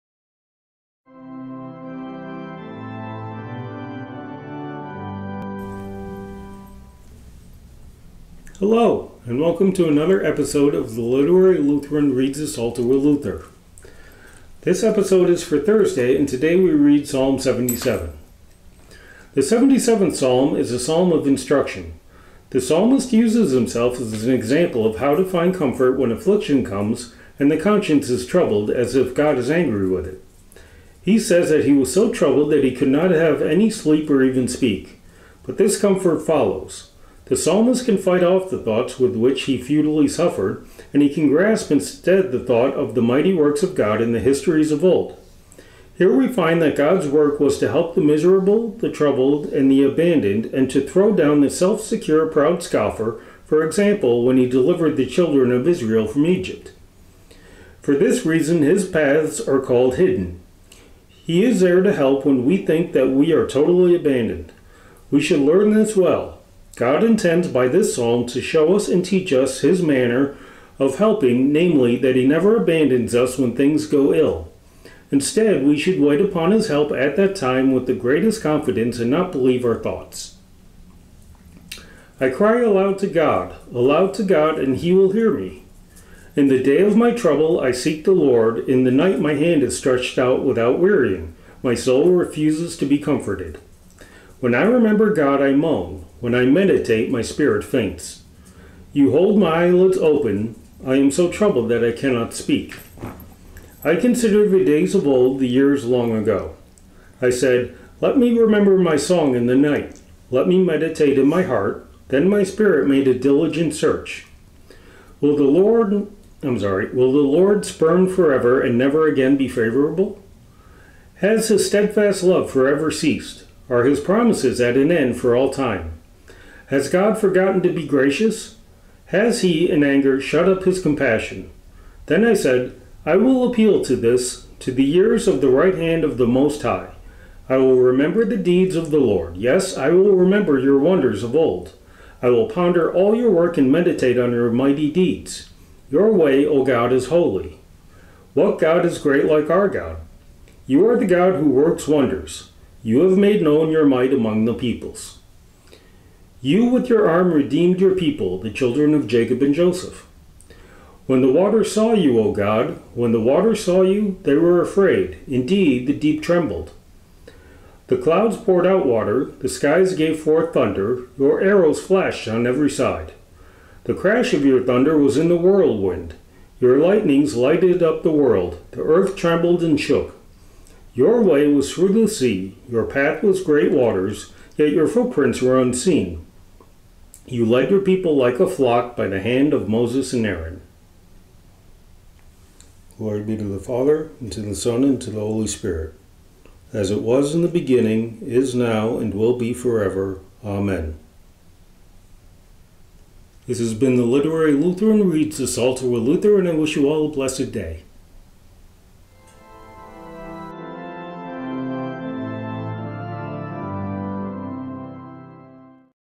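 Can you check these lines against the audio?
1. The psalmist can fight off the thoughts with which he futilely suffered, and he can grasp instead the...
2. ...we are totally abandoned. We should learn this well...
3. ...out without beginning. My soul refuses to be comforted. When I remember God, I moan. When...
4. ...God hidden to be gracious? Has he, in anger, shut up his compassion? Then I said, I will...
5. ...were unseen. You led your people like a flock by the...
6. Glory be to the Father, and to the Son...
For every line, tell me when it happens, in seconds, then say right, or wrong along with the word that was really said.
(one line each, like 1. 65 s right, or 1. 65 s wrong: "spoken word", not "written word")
1. 37 s right
2. 63 s right
3. 90 s wrong: "wearying", not "beginning"
4. 126 s wrong: "forgotten", not "hidden"
5. 185 s right
6. 192 s right.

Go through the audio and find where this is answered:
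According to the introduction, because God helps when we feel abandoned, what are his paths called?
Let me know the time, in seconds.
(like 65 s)
59 s.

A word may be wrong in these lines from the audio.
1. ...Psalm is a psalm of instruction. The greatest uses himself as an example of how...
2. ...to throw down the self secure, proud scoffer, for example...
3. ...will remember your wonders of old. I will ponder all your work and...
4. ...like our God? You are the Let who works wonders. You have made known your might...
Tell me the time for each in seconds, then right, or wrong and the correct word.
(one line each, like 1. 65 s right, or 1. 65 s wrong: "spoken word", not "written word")
1. 20 s wrong: "psalmist", not "greatest"
2. 50 s right
3. 139 s right
4. 149 s wrong: "God", not "Let".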